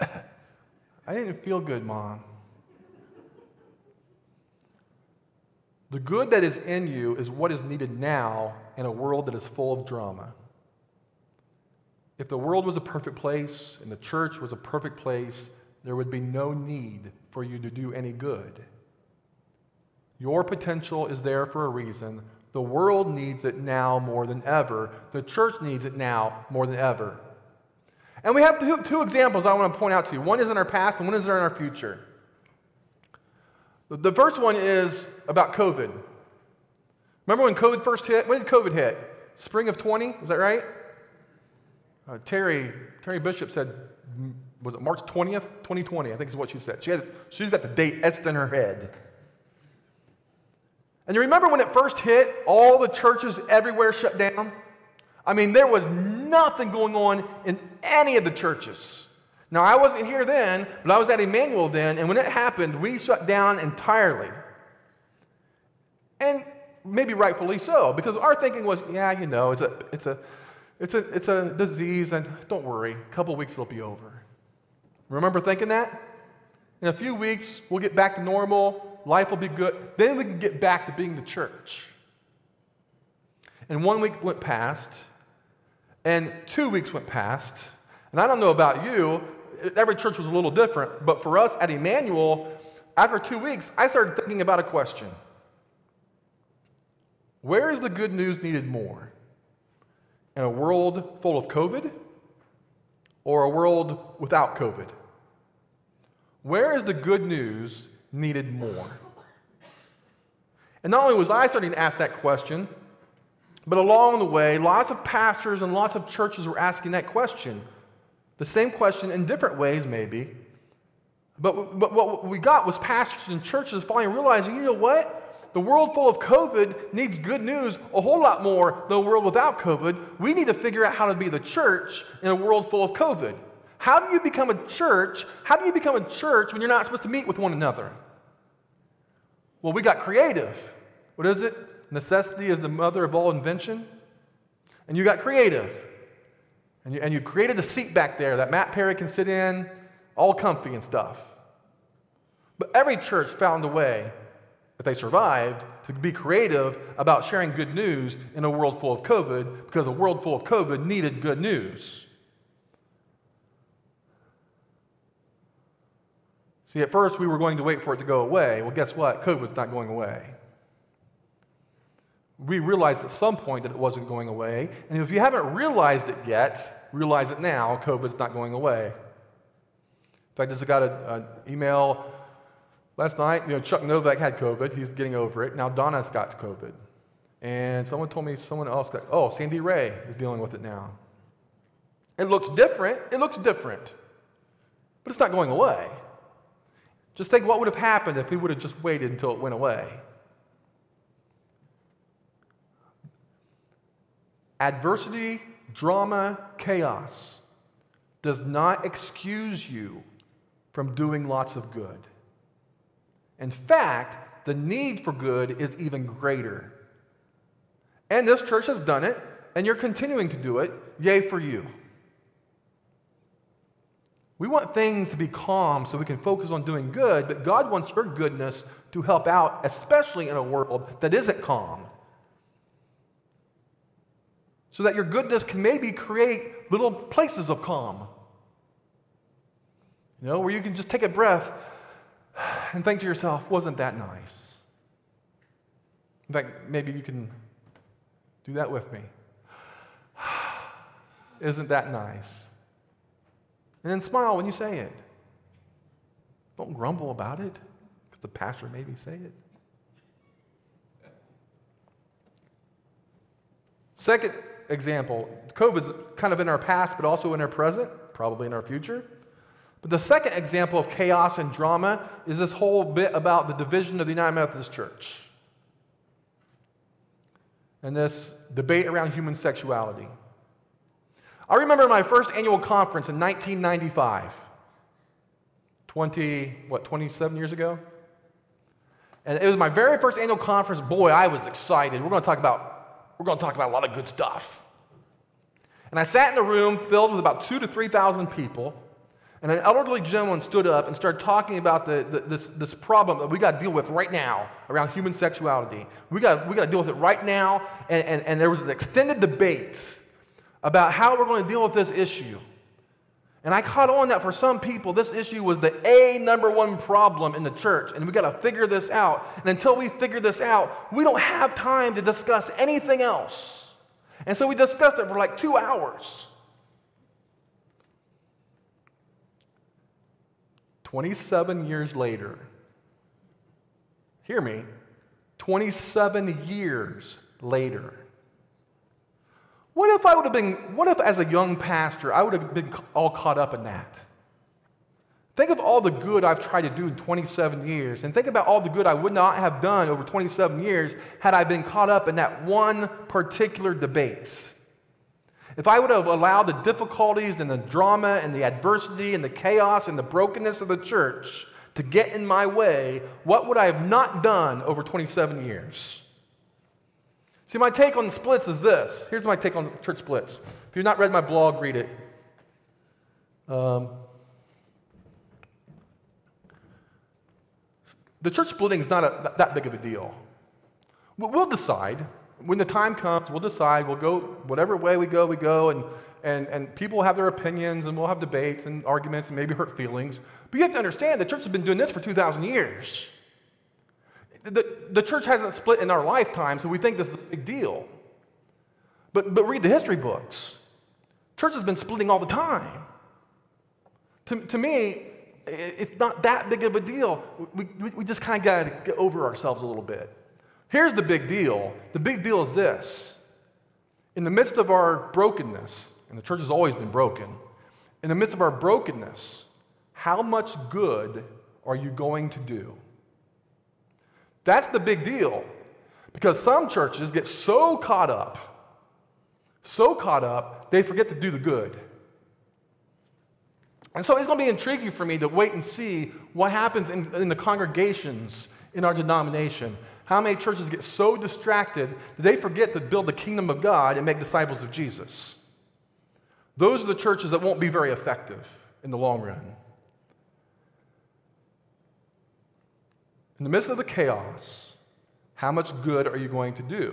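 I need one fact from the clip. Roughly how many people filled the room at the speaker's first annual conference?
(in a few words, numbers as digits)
2,000 to 3,000.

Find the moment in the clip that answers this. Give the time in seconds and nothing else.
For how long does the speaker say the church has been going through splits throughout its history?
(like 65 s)
391 s.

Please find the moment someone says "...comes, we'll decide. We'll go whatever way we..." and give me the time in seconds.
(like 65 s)
382 s.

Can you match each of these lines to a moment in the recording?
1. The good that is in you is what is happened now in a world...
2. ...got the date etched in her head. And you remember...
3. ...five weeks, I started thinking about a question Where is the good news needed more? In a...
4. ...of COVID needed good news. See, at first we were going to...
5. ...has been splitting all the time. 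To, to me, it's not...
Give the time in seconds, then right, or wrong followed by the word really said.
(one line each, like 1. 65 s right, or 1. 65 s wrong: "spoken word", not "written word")
1. 5 s wrong: "needed", not "happened"
2. 47 s right
3. 93 s wrong: "two", not "five"
4. 160 s right
5. 401 s right.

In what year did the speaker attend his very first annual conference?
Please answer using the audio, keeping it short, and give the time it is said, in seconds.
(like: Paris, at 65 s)
1995, at 283 s.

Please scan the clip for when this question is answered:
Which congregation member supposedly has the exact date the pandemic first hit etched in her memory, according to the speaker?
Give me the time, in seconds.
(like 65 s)
43 s.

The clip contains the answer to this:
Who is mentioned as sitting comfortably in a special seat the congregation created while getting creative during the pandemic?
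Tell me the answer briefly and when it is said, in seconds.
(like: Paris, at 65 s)
Matt Perry, at 148 s.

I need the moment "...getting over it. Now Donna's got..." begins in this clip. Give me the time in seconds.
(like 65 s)
184 s.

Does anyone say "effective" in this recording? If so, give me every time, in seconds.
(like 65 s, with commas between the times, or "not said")
447 s.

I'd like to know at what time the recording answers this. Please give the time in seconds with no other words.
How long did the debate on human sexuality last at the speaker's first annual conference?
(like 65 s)
325 s.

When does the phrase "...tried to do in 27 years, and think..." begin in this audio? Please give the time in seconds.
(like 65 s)
346 s.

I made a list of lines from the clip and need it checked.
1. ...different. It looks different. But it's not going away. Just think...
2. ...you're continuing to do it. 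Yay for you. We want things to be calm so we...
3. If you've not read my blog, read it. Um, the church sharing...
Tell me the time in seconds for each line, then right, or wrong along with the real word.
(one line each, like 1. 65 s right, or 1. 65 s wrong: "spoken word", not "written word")
1. 192 s right
2. 219 s right
3. 370 s wrong: "splitting", not "sharing".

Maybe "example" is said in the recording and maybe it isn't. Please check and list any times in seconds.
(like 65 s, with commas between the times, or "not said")
29 s, 264 s, 270 s.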